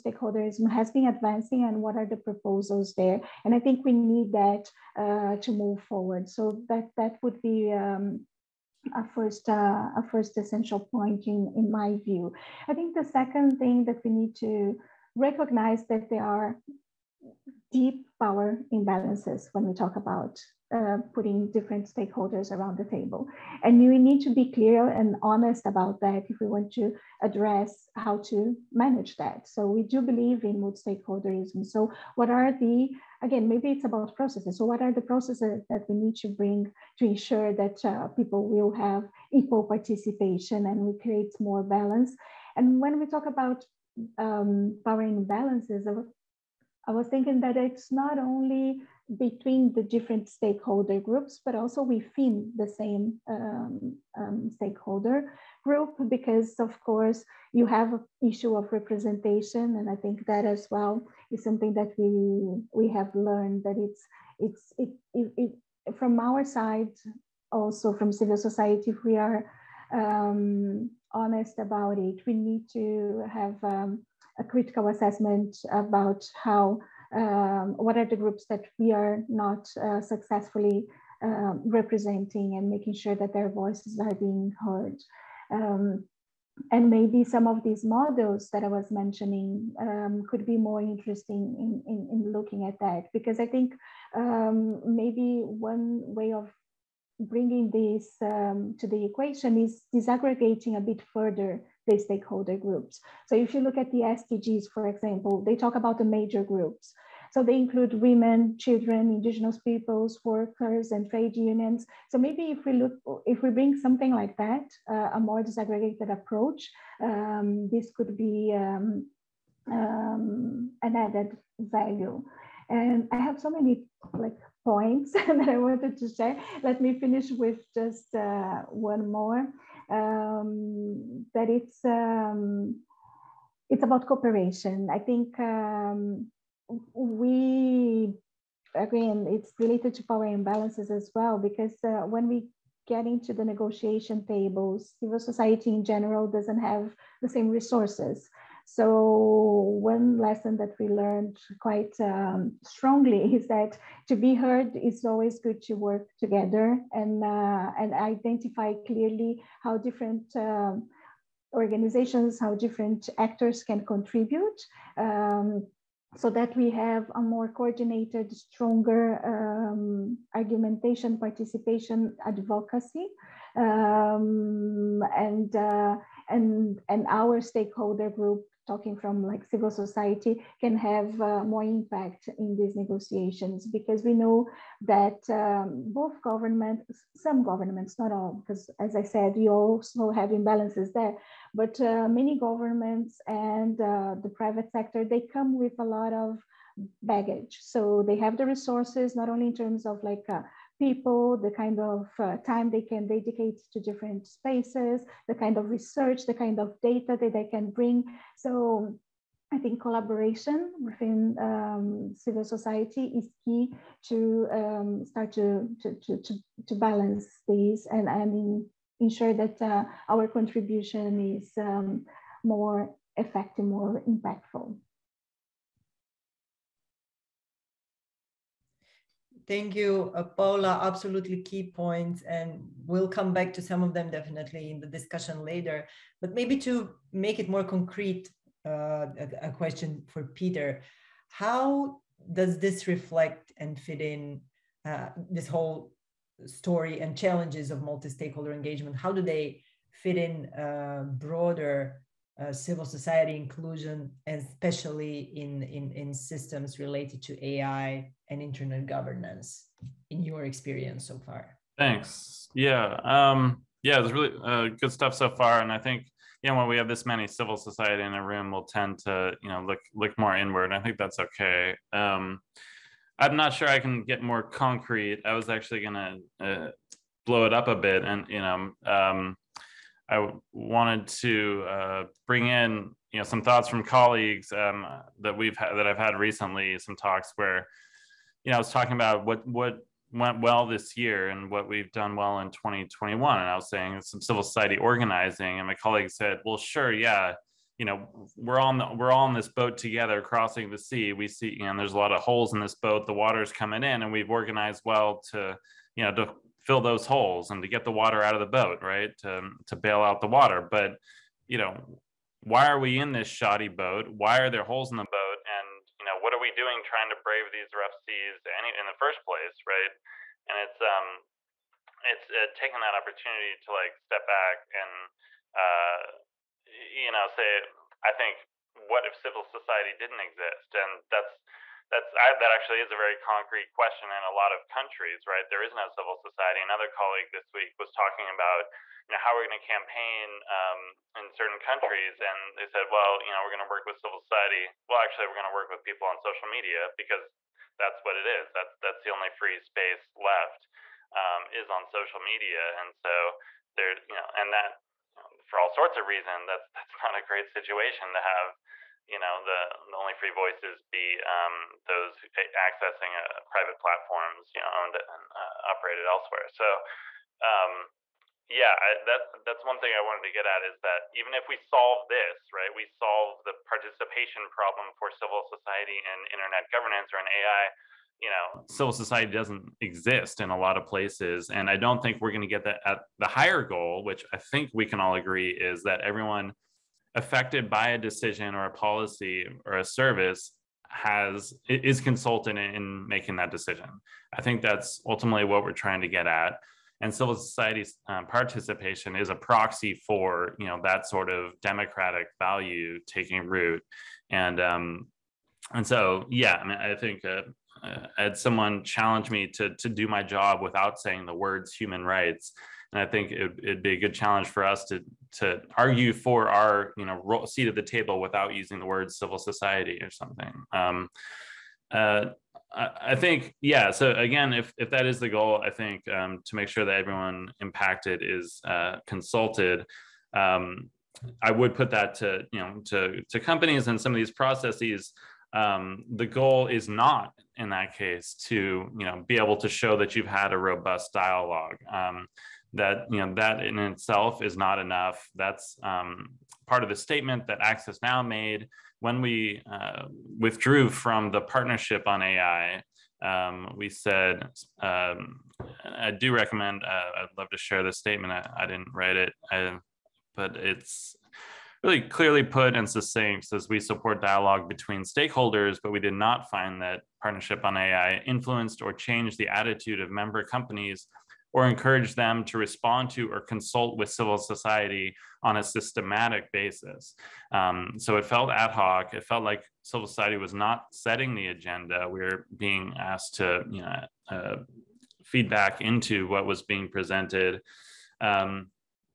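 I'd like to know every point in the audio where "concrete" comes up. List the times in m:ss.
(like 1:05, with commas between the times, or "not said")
3:57, 4:34, 5:33.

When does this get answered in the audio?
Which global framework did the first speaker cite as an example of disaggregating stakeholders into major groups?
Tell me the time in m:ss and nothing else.
1:43.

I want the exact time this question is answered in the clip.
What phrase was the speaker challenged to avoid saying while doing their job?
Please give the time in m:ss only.
6:51.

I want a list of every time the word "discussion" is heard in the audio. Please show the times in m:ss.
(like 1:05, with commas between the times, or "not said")
3:54.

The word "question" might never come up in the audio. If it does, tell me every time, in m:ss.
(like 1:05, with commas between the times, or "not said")
3:59, 5:33.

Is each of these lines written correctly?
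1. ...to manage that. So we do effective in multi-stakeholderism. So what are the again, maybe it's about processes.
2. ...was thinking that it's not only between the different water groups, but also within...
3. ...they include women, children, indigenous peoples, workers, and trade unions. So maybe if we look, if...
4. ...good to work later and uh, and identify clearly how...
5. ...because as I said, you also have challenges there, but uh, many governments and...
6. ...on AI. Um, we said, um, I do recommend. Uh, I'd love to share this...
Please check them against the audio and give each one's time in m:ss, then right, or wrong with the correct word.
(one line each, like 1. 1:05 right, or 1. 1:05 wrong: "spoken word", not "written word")
1. 0:28 wrong: "believe", not "effective"
2. 0:46 wrong: "stakeholder", not "water"
3. 1:47 right
4. 2:35 wrong: "together", not "later"
5. 3:08 wrong: "imbalances", not "challenges"
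6. 7:32 right.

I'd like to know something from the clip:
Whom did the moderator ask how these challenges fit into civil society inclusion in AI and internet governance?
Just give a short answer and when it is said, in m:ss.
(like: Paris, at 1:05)
Peter, at 4:00.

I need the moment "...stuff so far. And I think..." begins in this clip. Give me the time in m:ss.
4:24.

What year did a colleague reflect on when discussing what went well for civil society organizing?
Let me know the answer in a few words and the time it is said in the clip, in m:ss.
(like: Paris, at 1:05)
2021, at 4:52.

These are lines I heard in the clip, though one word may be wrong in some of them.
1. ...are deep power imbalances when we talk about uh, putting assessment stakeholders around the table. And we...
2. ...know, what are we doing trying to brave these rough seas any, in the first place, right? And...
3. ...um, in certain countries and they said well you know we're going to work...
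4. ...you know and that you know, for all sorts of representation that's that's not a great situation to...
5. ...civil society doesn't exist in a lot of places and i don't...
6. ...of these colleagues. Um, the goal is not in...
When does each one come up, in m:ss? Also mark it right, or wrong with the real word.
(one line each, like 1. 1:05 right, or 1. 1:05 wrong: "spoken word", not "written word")
1. 0:16 wrong: "different", not "assessment"
2. 5:16 right
3. 5:40 right
4. 5:54 wrong: "reason", not "representation"
5. 6:18 right
6. 7:14 wrong: "processes", not "colleagues".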